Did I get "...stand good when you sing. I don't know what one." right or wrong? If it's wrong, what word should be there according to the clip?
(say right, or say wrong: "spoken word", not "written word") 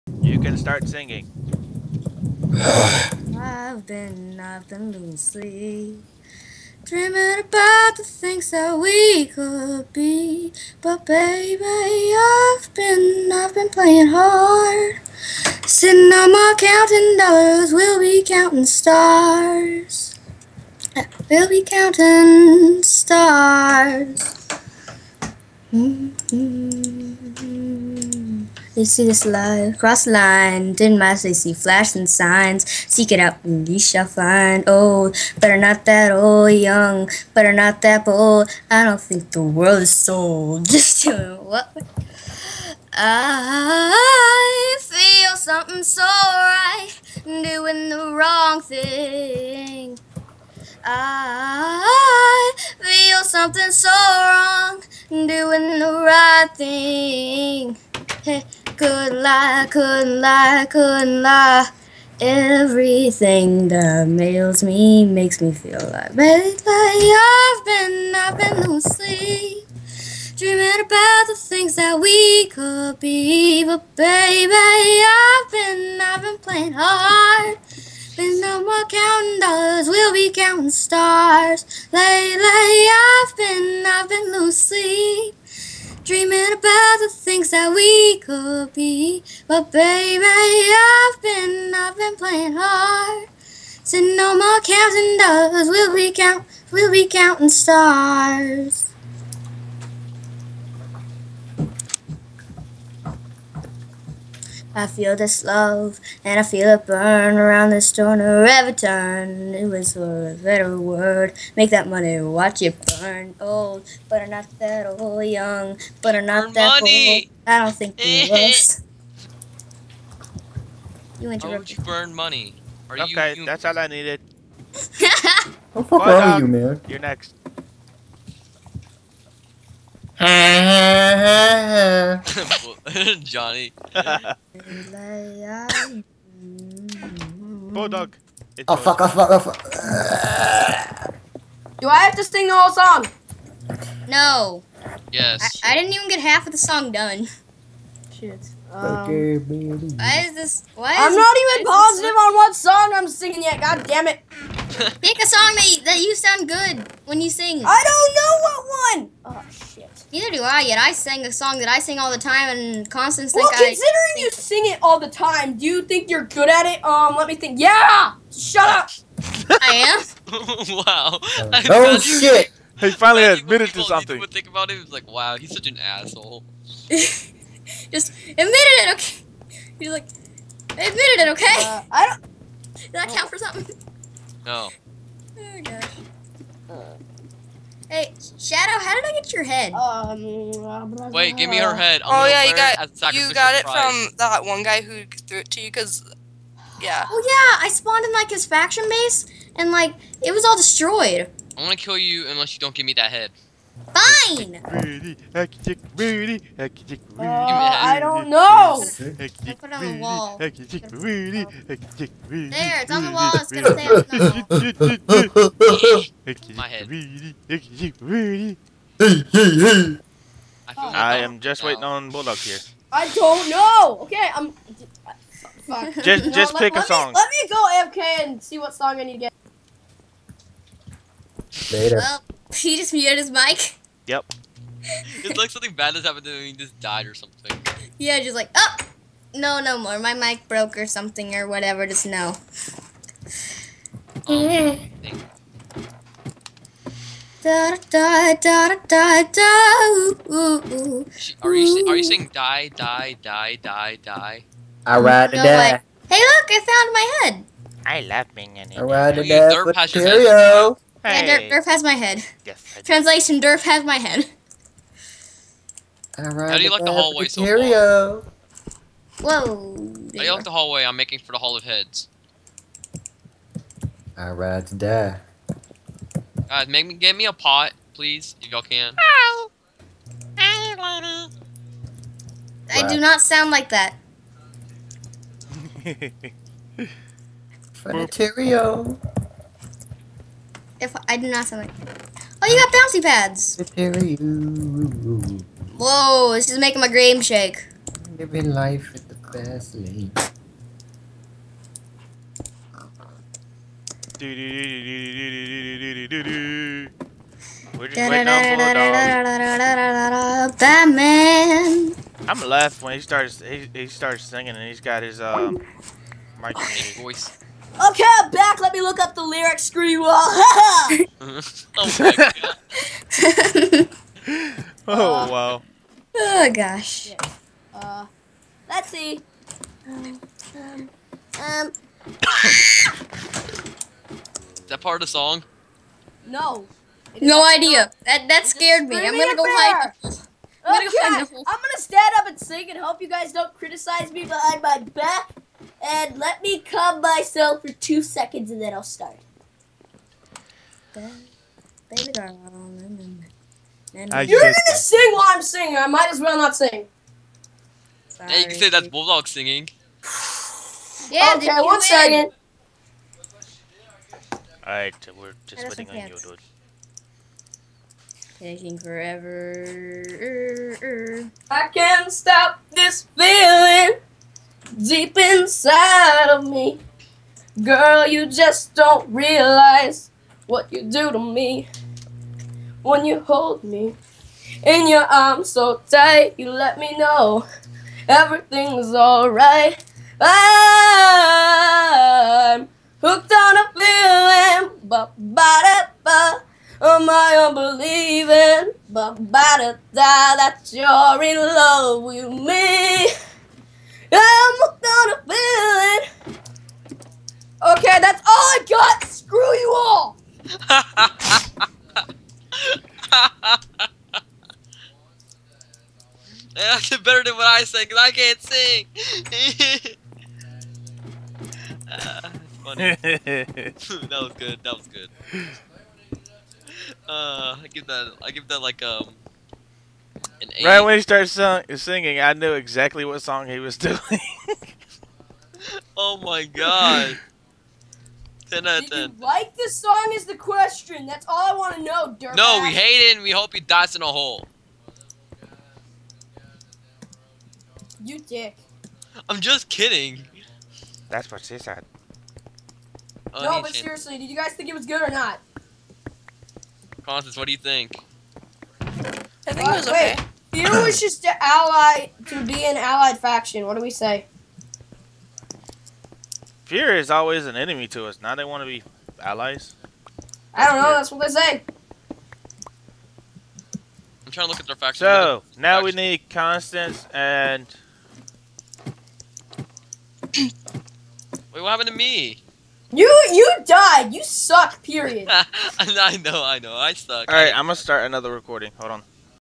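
wrong: "sound", not "stand".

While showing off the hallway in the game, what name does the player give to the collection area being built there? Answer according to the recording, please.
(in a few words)
Hall of Heads.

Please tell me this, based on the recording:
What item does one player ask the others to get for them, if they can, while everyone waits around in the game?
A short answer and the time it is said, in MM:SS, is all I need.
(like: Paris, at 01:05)
A pot, at 04:37.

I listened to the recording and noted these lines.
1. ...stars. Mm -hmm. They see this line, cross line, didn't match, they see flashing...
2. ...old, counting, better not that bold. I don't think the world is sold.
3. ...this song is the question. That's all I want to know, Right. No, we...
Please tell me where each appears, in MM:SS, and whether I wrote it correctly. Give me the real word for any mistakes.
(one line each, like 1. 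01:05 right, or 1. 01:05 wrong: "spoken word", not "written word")
1. 00:22 right
2. 00:36 wrong: "young", not "counting"
3. 07:19 wrong: "Dirk", not "Right".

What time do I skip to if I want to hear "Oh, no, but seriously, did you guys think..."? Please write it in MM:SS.
07:33.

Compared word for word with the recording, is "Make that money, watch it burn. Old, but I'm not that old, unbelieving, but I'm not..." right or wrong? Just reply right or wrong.
wrong.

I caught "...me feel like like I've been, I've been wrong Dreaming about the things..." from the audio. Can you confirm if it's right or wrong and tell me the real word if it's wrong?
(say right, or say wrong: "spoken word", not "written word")
wrong: "losing", not "wrong".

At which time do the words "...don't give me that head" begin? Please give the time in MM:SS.
03:22.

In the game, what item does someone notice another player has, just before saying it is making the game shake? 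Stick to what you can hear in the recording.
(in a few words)
Bouncy pads.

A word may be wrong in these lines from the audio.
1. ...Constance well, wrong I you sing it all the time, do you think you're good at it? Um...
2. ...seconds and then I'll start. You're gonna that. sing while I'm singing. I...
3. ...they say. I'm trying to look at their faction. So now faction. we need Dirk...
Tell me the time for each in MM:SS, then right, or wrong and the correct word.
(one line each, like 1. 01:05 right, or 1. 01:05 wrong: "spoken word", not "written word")
1. 02:42 wrong: "considering", not "wrong"
2. 05:48 right
3. 07:51 wrong: "Constance", not "Dirk".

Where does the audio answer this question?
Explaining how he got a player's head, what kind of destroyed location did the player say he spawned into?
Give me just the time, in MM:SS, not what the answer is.
03:18.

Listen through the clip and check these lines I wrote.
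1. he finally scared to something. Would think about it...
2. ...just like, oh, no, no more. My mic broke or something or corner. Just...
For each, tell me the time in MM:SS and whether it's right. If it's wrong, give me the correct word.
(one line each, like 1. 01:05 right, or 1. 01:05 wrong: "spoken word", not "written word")
1. 02:52 wrong: "admitted", not "scared"
2. 03:58 wrong: "whatever", not "corner".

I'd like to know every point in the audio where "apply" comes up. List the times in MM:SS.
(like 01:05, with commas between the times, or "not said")
not said.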